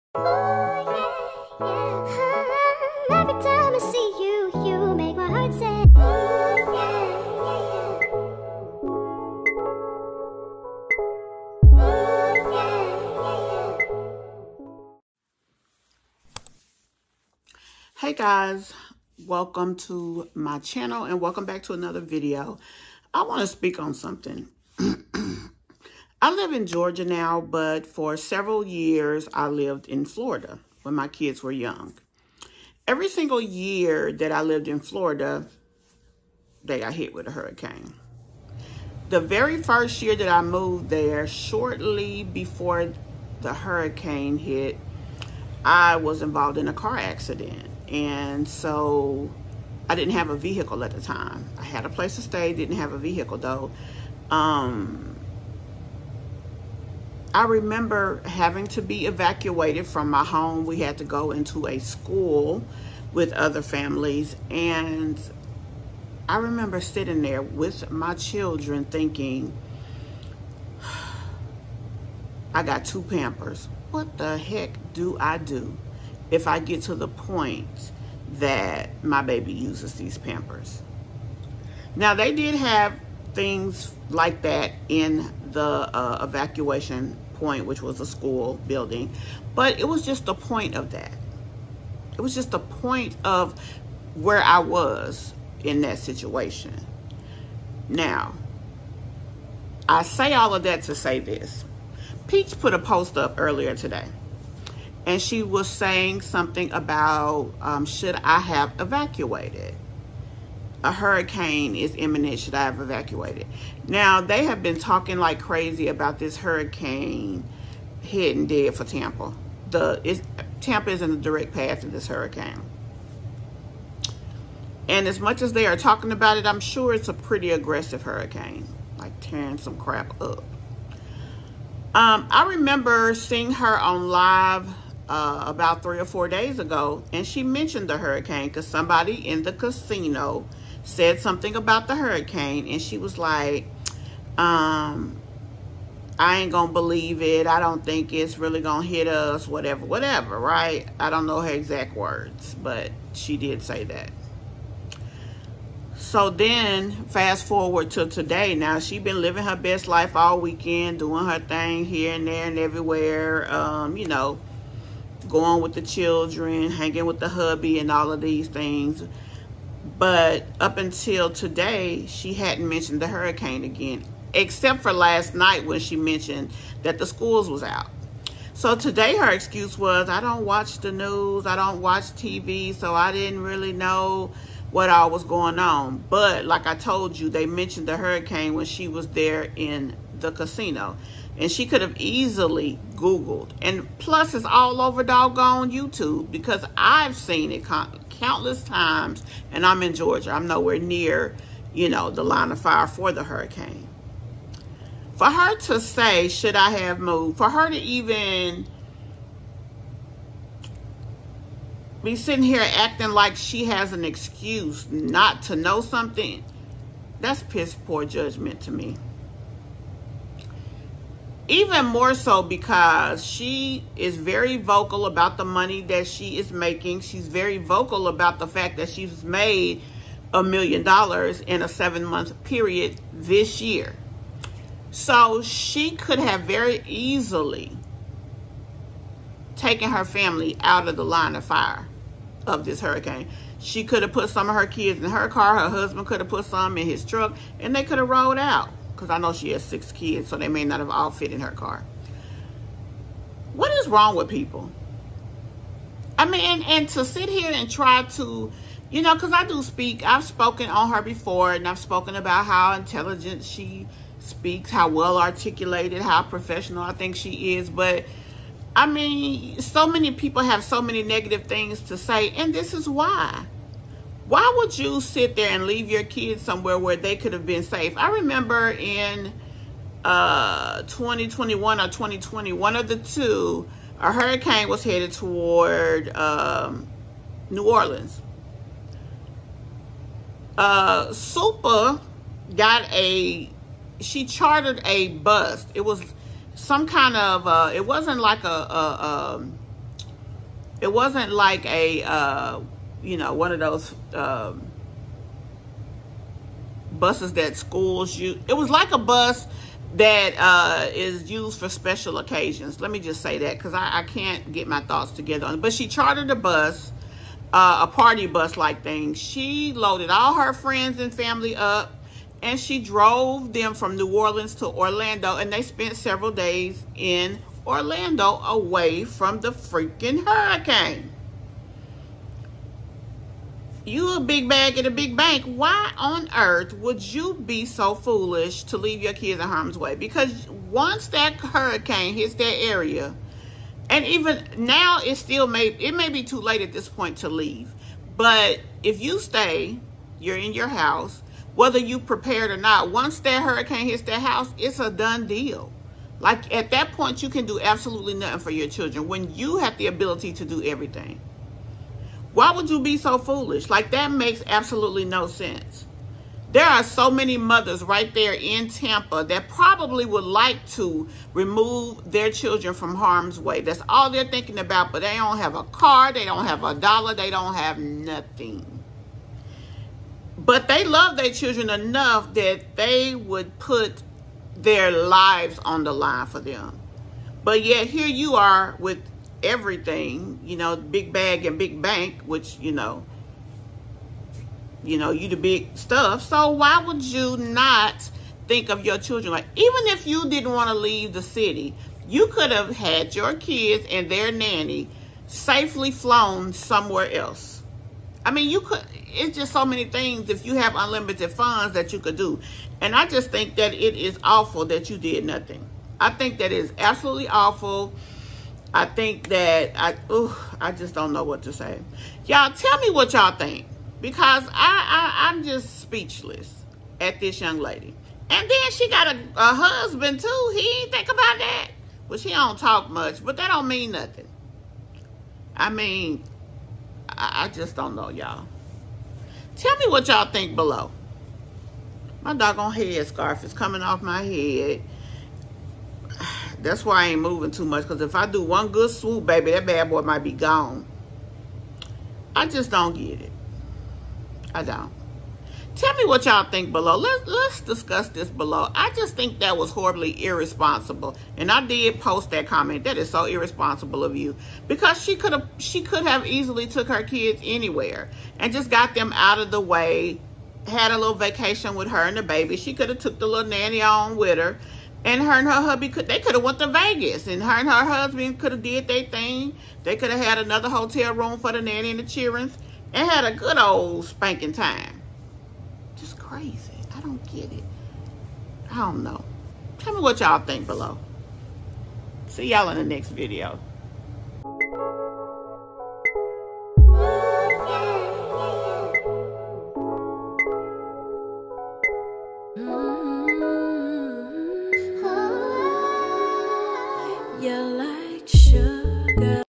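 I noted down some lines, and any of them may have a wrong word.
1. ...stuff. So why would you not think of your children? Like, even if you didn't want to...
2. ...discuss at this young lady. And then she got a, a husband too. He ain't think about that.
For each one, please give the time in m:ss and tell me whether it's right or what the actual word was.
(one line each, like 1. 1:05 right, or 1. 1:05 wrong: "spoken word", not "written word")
1. 6:35 right
2. 7:05 wrong: "speechless", not "discuss".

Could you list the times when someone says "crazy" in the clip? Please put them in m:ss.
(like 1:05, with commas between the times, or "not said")
1:55, 8:06.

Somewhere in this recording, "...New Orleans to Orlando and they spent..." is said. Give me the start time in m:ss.
5:23.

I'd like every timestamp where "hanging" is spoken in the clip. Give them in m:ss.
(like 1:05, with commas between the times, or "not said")
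2:46.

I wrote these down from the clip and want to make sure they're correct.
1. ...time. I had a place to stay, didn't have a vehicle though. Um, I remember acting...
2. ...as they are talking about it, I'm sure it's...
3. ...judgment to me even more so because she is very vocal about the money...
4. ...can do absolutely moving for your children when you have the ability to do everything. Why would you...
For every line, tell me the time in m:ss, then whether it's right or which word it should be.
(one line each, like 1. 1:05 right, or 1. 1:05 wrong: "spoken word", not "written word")
1. 0:51 wrong: "having", not "acting"
2. 2:05 right
3. 3:38 right
4. 5:57 wrong: "nothing", not "moving".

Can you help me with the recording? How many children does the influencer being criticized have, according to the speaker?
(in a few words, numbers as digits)
6.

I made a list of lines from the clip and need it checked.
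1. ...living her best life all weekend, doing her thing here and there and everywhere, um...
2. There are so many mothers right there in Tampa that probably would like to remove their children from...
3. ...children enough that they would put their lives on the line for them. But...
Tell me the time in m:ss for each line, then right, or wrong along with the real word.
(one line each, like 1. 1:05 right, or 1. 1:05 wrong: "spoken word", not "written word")
1. 2:39 right
2. 6:06 right
3. 6:21 right.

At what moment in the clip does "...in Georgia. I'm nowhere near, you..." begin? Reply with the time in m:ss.
3:19.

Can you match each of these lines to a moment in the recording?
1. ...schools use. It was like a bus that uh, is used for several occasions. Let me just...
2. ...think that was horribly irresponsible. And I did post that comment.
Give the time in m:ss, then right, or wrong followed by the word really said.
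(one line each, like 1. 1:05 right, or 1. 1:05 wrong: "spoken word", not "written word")
1. 5:07 wrong: "special", not "several"
2. 7:39 right.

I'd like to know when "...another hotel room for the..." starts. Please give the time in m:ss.
8:00.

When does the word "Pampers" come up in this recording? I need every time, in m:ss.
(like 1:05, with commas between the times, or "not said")
1:13, 1:20.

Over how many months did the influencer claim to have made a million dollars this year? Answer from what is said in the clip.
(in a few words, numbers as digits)
7.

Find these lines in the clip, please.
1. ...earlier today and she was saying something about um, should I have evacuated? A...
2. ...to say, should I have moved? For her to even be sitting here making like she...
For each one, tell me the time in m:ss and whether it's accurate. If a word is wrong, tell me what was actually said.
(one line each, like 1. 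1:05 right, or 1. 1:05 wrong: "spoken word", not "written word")
1. 1:43 right
2. 3:25 wrong: "acting", not "making".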